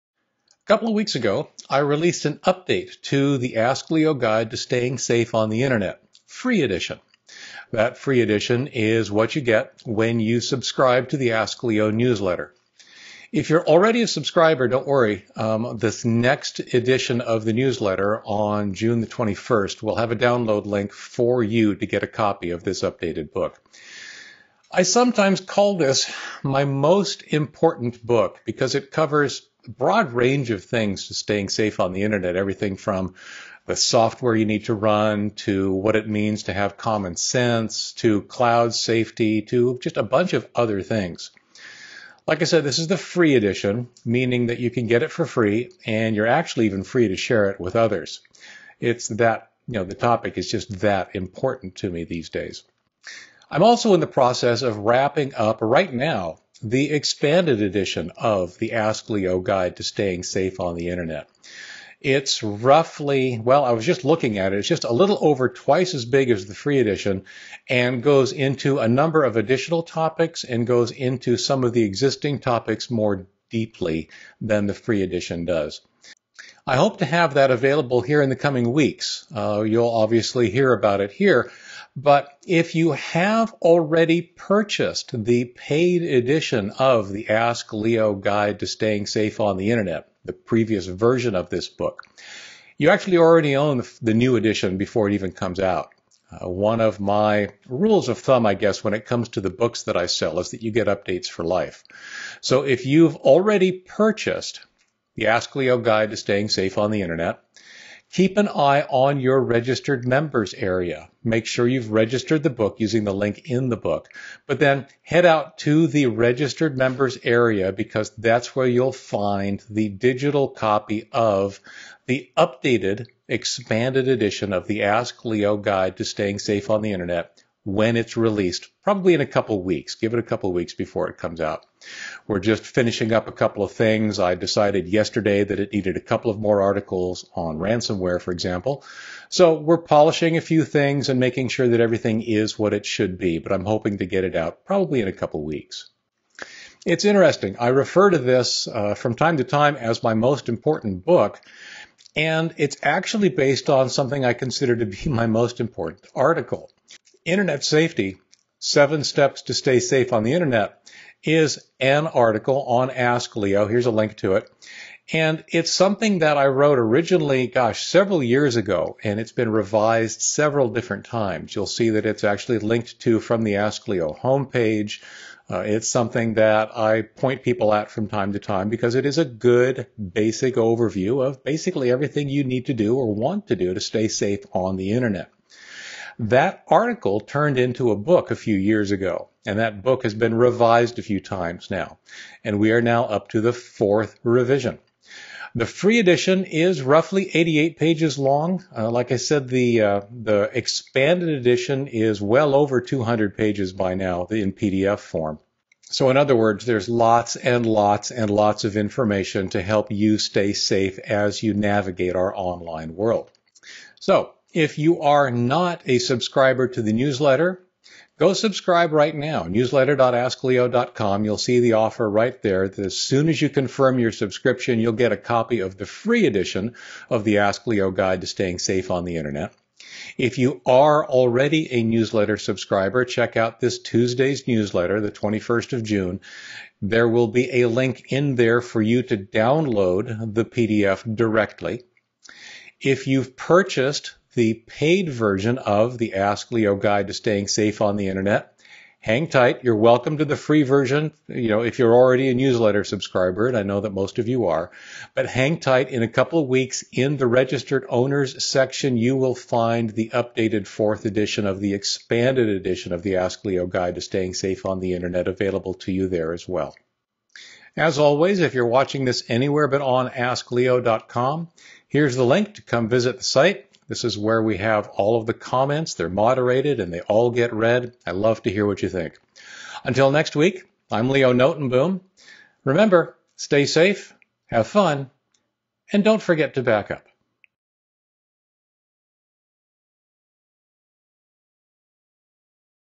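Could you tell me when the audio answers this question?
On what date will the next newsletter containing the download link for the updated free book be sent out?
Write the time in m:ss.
0:18.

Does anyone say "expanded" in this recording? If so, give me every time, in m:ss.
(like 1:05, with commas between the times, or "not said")
0:56, 2:03, 3:20, 4:21.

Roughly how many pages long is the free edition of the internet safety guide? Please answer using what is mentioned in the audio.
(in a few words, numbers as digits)
88.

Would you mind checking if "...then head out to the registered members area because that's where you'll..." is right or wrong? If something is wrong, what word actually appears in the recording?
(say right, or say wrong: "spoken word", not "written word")
right.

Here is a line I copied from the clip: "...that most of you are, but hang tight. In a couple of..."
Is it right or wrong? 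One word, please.
right.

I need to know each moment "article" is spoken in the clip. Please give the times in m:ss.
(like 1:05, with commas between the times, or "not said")
2:16, 2:36, 2:42, 3:06.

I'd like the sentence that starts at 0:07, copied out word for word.
That free edition is what you get when you subscribe to the Ask Leo newsletter.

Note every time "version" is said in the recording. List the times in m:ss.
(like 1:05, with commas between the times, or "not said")
1:30, 4:05, 4:10.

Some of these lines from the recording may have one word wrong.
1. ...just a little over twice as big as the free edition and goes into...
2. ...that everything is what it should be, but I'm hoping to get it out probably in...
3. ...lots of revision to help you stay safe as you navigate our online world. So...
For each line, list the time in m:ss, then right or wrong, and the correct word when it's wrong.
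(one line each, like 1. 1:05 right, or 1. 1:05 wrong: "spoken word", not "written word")
1. 1:04 right
2. 2:21 right
3. 3:28 wrong: "information", not "revision".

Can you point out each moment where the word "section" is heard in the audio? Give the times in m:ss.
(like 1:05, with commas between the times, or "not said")
4:18.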